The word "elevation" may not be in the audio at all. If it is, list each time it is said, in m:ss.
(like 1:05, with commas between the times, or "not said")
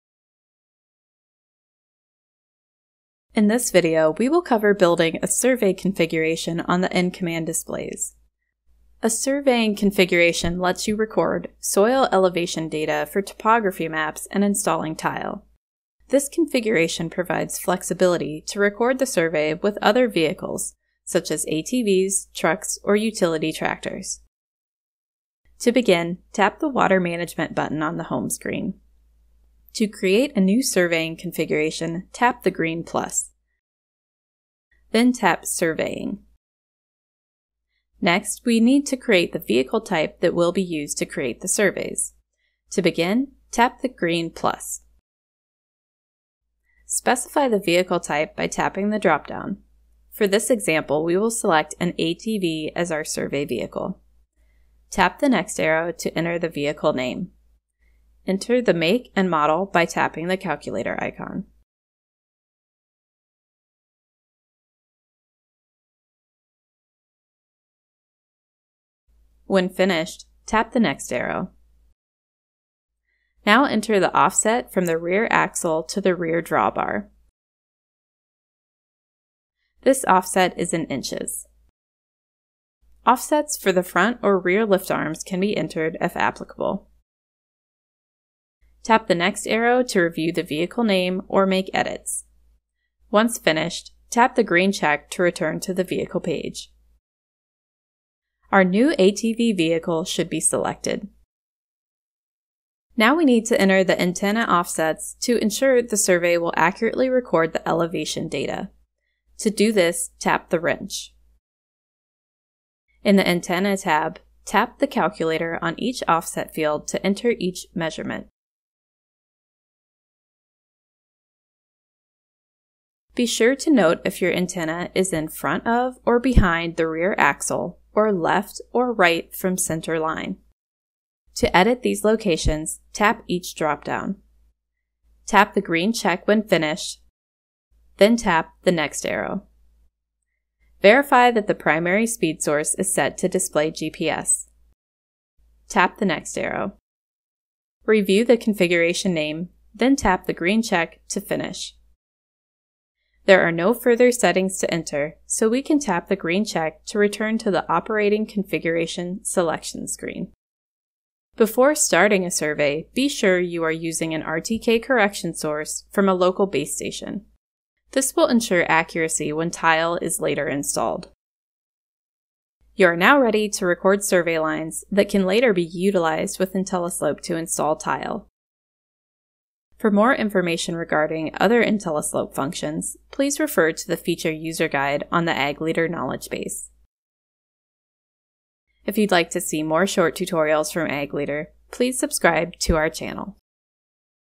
0:12, 1:47.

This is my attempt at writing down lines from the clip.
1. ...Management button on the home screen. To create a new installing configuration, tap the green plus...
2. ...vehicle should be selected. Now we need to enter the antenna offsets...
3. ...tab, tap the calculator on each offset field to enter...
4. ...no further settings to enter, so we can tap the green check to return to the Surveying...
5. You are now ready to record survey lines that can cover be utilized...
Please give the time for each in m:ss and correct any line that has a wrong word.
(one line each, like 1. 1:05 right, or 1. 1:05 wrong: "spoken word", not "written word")
1. 0:26 wrong: "surveying", not "installing"
2. 1:39 right
3. 1:53 right
4. 2:33 wrong: "Operating", not "Surveying"
5. 2:52 wrong: "later", not "cover".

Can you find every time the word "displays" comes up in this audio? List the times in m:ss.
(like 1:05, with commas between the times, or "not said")
0:07, 2:23.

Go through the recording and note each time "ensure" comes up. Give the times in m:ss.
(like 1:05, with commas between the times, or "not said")
1:45, 2:48.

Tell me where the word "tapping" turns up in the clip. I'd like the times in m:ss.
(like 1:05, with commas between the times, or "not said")
0:48, 0:59.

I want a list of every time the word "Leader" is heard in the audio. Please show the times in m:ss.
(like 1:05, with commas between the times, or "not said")
3:05, 3:11.